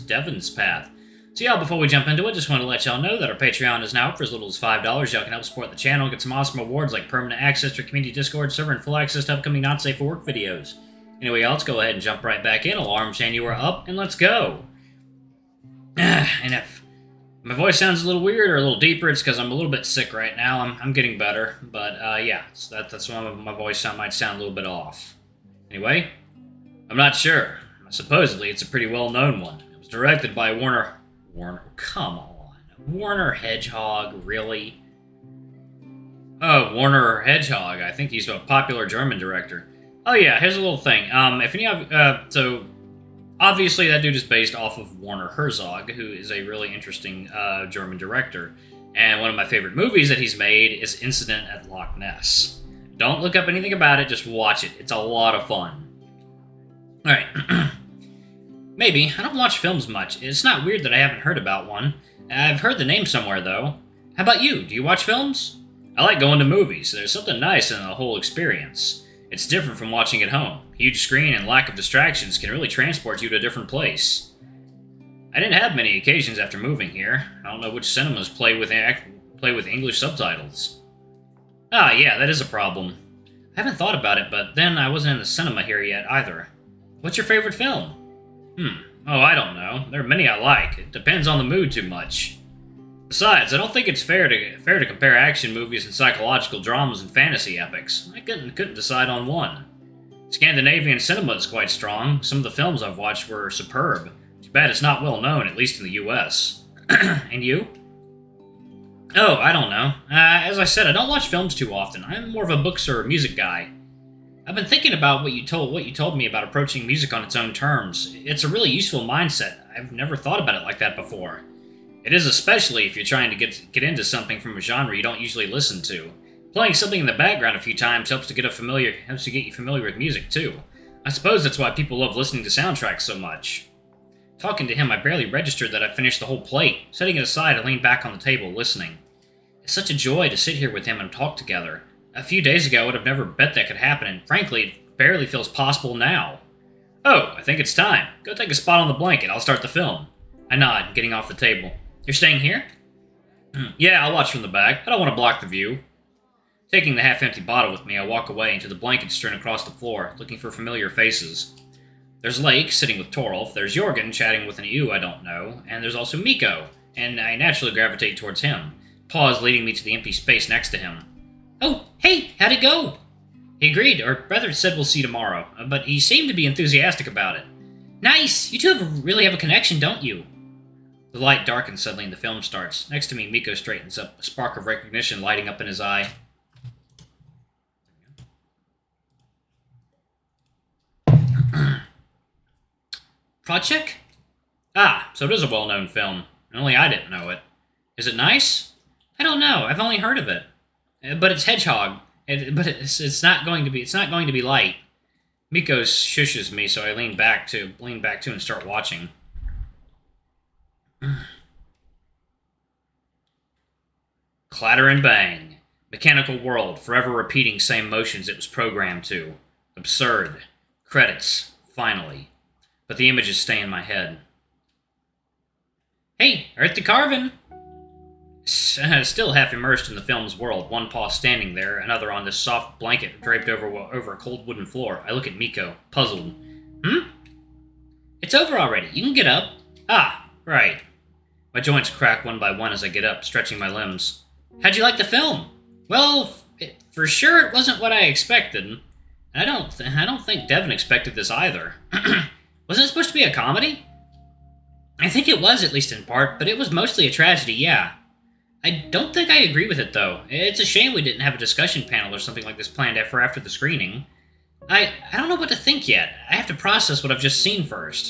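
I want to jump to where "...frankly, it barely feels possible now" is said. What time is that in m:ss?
2:24.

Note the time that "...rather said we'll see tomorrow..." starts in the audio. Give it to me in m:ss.
2:54.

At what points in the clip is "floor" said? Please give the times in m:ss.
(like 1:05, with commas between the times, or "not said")
2:39, 3:54.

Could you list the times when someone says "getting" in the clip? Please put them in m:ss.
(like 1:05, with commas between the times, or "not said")
0:20, 2:30.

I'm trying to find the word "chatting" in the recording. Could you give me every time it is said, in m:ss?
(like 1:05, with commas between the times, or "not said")
2:44.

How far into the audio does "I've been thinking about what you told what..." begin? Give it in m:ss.
1:54.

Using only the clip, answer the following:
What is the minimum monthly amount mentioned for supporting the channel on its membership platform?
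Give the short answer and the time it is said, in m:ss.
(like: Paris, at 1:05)
$5, at 0:04.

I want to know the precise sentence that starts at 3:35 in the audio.
Mechanical world, forever repeating same motions it was programmed to.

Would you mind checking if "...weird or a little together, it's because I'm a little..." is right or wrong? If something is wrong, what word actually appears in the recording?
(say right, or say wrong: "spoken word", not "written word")
wrong: "deeper", not "together".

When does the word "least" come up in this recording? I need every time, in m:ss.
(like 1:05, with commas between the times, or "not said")
1:45, 4:15.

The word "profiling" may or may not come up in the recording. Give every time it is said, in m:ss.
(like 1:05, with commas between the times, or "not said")
not said.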